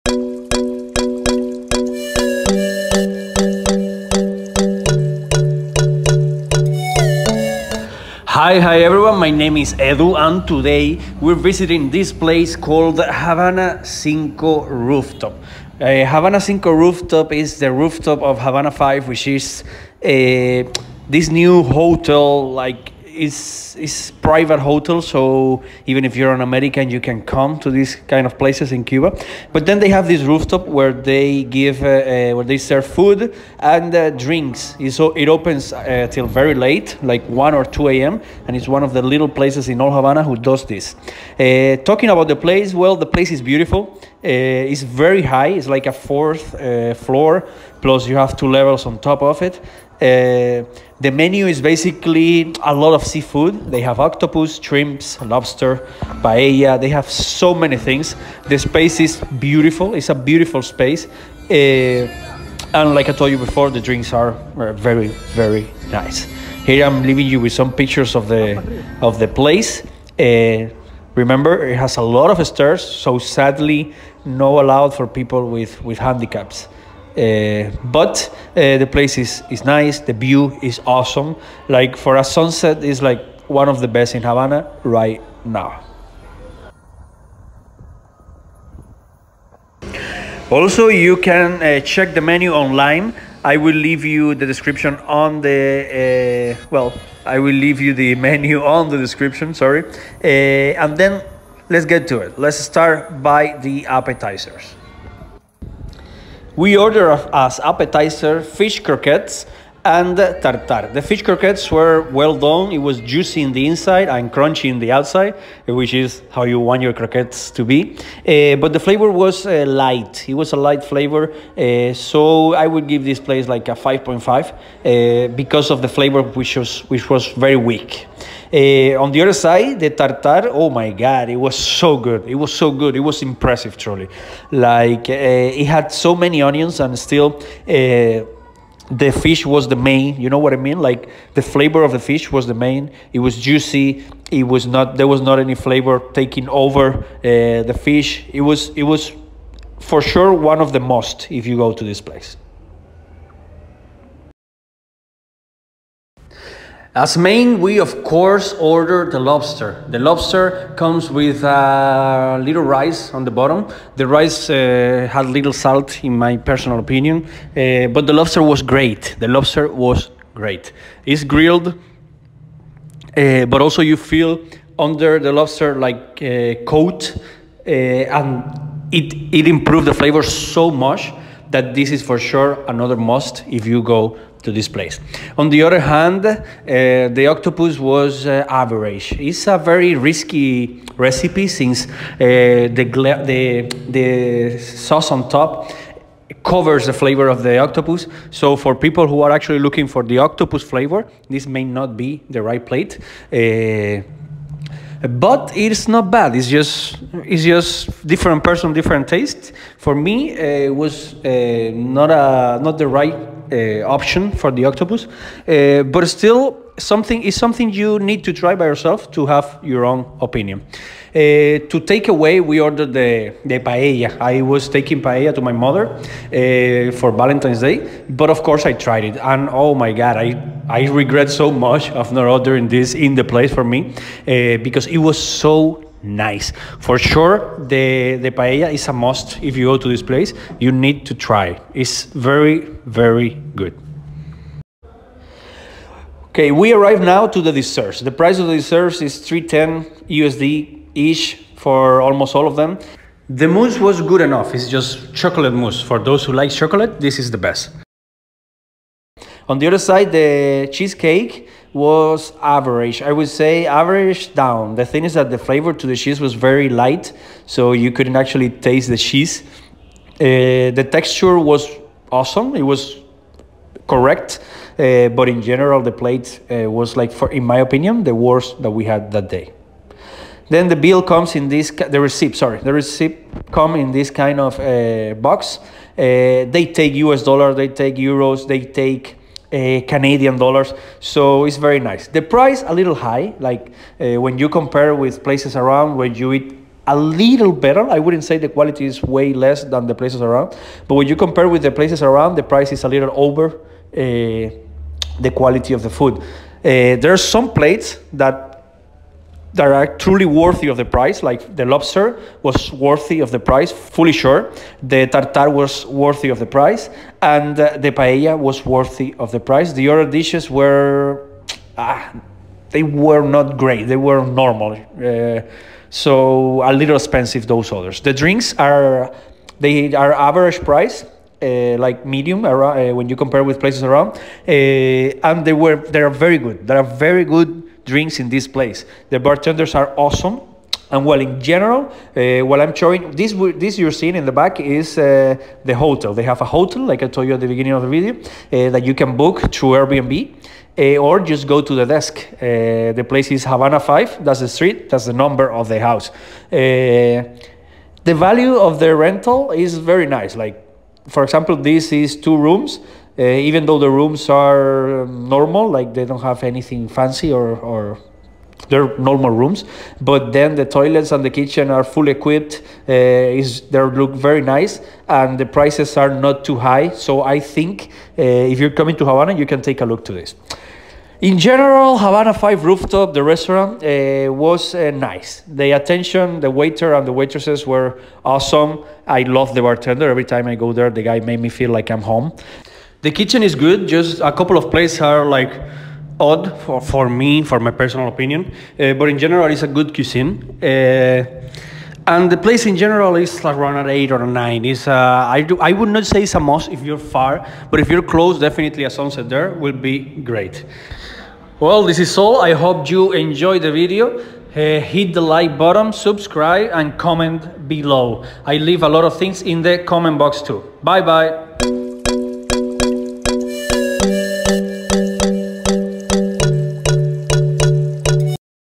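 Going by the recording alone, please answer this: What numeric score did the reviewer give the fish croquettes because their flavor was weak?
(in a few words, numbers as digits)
5.5.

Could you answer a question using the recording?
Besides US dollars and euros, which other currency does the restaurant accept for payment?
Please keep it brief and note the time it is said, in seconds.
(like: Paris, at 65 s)
Canadian dollars, at 289 s.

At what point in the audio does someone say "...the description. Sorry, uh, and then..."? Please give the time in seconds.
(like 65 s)
98 s.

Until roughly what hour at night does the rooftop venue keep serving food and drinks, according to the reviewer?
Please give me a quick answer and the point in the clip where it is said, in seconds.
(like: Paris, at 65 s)
1 or 2 a.m., at 37 s.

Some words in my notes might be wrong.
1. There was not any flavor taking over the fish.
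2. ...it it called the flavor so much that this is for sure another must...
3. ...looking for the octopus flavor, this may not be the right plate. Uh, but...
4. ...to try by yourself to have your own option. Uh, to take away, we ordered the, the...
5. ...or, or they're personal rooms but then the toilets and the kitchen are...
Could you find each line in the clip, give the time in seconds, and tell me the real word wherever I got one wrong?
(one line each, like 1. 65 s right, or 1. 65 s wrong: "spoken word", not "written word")
1. 144 s right
2. 178 s wrong: "improved", not "called"
3. 199 s right
4. 218 s wrong: "opinion", not "option"
5. 367 s wrong: "normal", not "personal".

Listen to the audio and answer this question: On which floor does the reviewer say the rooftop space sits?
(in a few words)
Fourth floor.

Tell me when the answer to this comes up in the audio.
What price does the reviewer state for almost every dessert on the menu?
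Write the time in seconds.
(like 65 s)
249 s.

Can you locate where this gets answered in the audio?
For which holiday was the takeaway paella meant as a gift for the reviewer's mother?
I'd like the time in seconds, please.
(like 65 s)
227 s.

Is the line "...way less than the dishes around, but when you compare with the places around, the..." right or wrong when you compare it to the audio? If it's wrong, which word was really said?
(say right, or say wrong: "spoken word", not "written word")
wrong: "places", not "dishes".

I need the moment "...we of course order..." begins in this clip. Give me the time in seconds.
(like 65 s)
157 s.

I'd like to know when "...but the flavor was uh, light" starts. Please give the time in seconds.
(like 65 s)
118 s.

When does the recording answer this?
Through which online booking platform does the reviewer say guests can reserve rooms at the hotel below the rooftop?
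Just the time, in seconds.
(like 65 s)
349 s.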